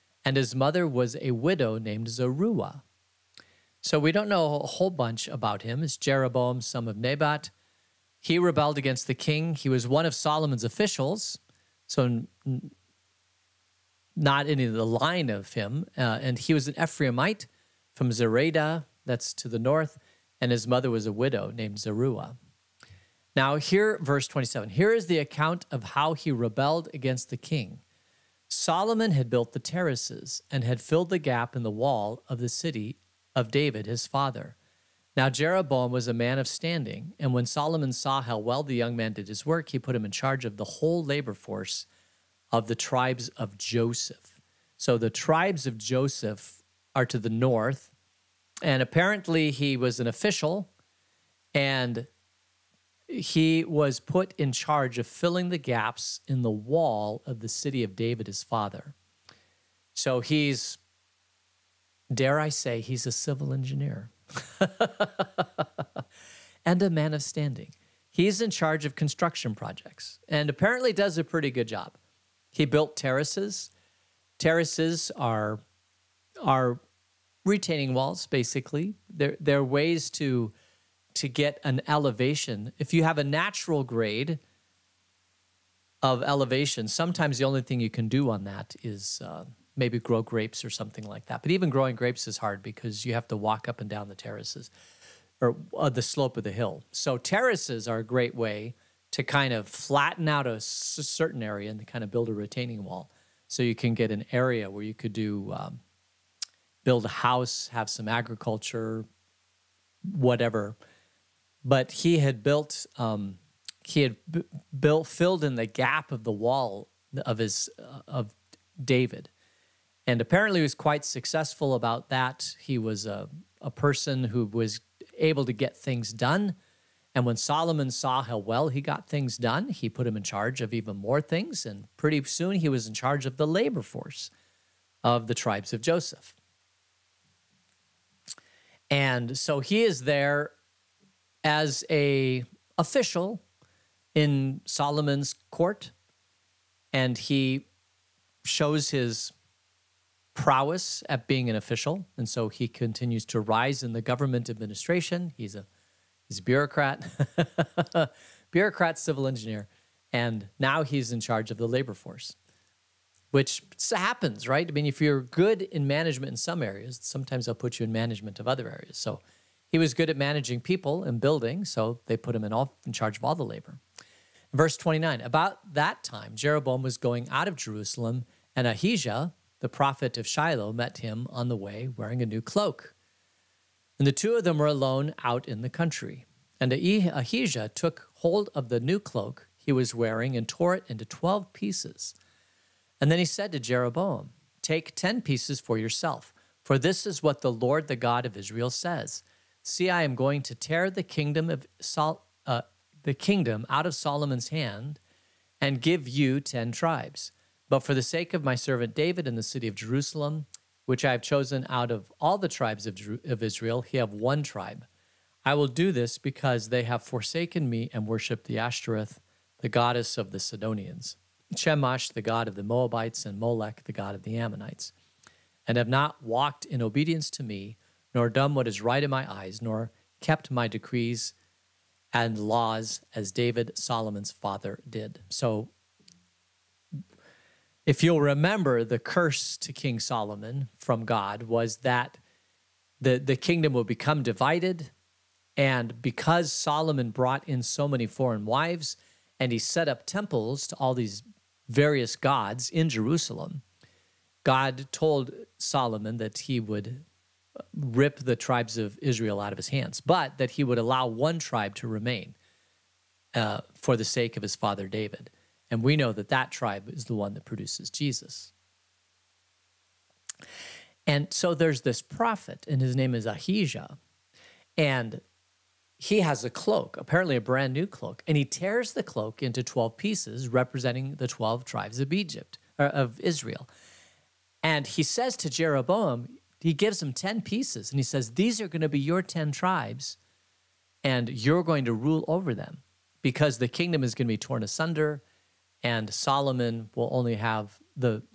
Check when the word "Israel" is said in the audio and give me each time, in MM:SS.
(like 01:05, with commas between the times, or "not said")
03:18, 03:33, 04:19, 04:43.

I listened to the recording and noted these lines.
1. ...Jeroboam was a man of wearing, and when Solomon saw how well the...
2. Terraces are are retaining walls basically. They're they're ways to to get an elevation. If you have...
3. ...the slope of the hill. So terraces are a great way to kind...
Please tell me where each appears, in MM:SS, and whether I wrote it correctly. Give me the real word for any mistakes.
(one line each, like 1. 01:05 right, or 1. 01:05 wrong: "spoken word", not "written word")
1. 00:35 wrong: "standing", not "wearing"
2. 01:14 right
3. 01:35 right.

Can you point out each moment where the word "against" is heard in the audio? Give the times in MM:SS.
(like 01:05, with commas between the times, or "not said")
00:08, 00:26.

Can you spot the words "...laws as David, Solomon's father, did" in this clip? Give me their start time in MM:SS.
03:52.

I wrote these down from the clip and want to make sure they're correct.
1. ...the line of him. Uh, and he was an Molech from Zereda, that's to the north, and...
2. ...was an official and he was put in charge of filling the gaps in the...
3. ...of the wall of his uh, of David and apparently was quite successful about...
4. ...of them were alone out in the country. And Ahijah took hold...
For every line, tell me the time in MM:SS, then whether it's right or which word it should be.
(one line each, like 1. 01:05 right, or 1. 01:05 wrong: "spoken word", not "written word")
1. 00:14 wrong: "Ephraimite", not "Molech"
2. 00:49 right
3. 01:56 right
4. 03:04 right.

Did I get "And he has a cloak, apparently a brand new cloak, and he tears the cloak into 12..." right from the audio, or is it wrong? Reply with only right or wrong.
right.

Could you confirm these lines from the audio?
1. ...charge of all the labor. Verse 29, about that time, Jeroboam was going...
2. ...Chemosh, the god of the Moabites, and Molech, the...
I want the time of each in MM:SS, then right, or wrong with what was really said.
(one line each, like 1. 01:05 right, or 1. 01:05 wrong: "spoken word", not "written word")
1. 02:52 right
2. 03:41 right.